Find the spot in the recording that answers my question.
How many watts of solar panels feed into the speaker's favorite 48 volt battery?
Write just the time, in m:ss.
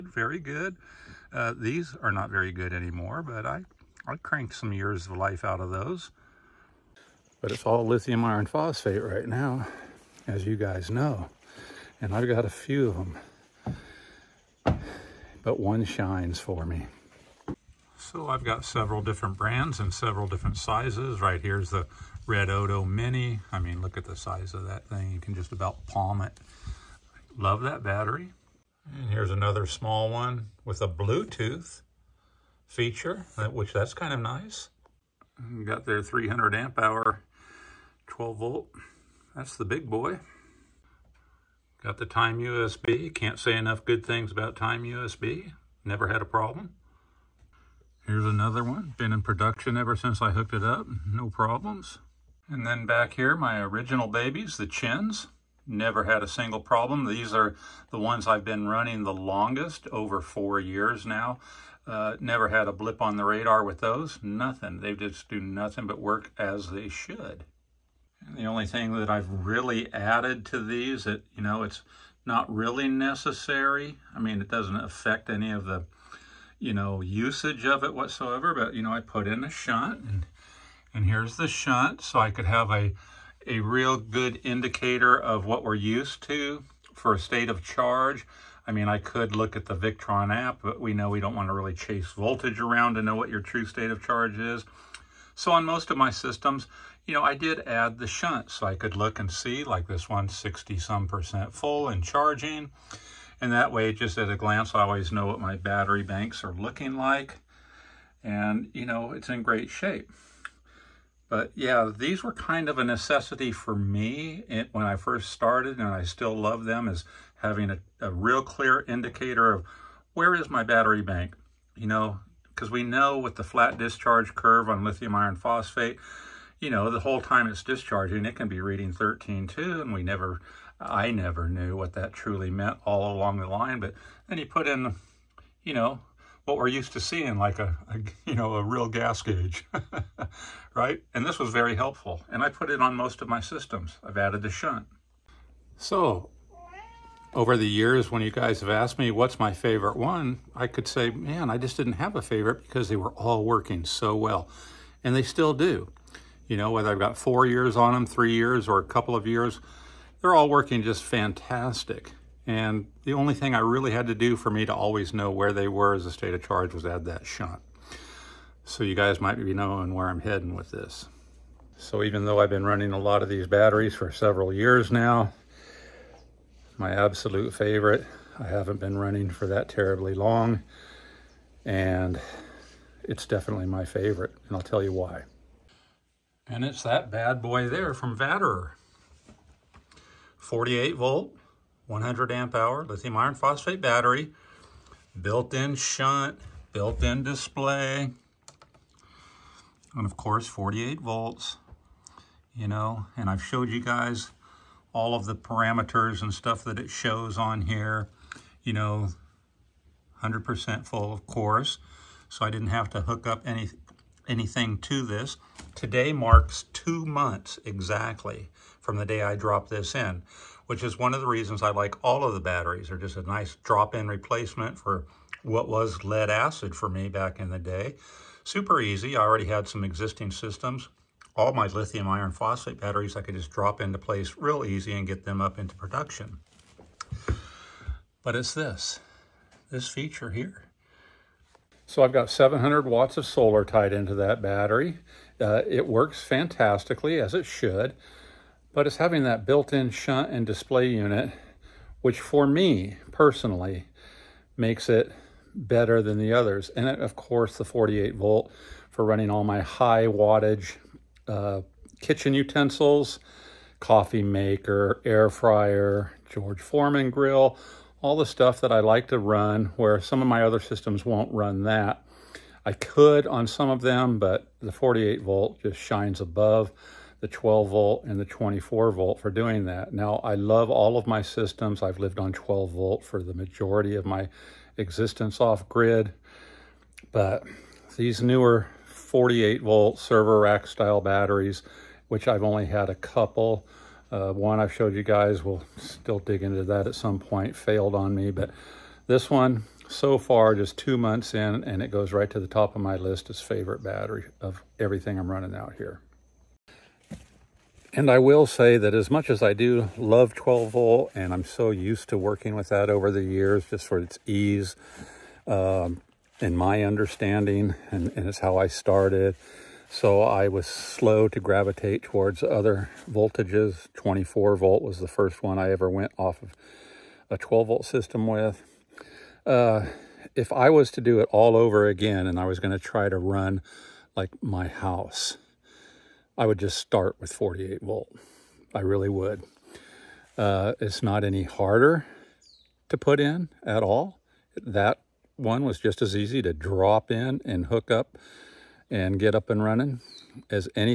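4:02.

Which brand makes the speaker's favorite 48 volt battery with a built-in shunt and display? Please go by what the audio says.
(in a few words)
Vatrer.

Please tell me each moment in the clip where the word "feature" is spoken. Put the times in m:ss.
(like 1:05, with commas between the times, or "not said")
0:32, 3:59.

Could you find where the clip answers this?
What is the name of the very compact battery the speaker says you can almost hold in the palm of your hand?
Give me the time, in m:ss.
0:22.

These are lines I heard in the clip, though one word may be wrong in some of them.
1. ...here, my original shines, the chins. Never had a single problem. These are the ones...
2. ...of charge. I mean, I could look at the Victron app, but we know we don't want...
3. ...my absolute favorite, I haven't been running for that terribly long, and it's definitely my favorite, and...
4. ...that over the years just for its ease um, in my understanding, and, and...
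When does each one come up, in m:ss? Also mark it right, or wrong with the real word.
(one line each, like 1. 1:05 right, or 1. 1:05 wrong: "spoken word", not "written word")
1. 0:53 wrong: "babies", not "shines"
2. 1:27 right
3. 2:56 right
4. 5:12 right.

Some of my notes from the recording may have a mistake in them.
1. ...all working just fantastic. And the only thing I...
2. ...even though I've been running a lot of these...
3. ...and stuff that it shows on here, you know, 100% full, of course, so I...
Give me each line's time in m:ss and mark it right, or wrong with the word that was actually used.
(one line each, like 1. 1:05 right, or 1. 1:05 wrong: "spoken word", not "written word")
1. 2:40 right
2. 2:52 right
3. 3:26 right.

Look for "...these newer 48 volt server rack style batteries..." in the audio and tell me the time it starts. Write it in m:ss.
4:47.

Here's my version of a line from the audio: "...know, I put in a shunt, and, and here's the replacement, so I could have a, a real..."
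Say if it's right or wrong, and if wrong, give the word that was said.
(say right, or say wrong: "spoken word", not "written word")
wrong: "shunt", not "replacement".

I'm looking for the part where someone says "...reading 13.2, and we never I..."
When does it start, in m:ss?
2:08.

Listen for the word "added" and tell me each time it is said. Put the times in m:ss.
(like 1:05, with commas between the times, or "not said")
1:09, 2:24.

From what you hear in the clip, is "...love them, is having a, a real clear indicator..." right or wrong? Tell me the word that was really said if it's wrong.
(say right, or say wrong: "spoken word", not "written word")
right.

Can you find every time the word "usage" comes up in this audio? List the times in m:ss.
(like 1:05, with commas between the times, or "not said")
1:17.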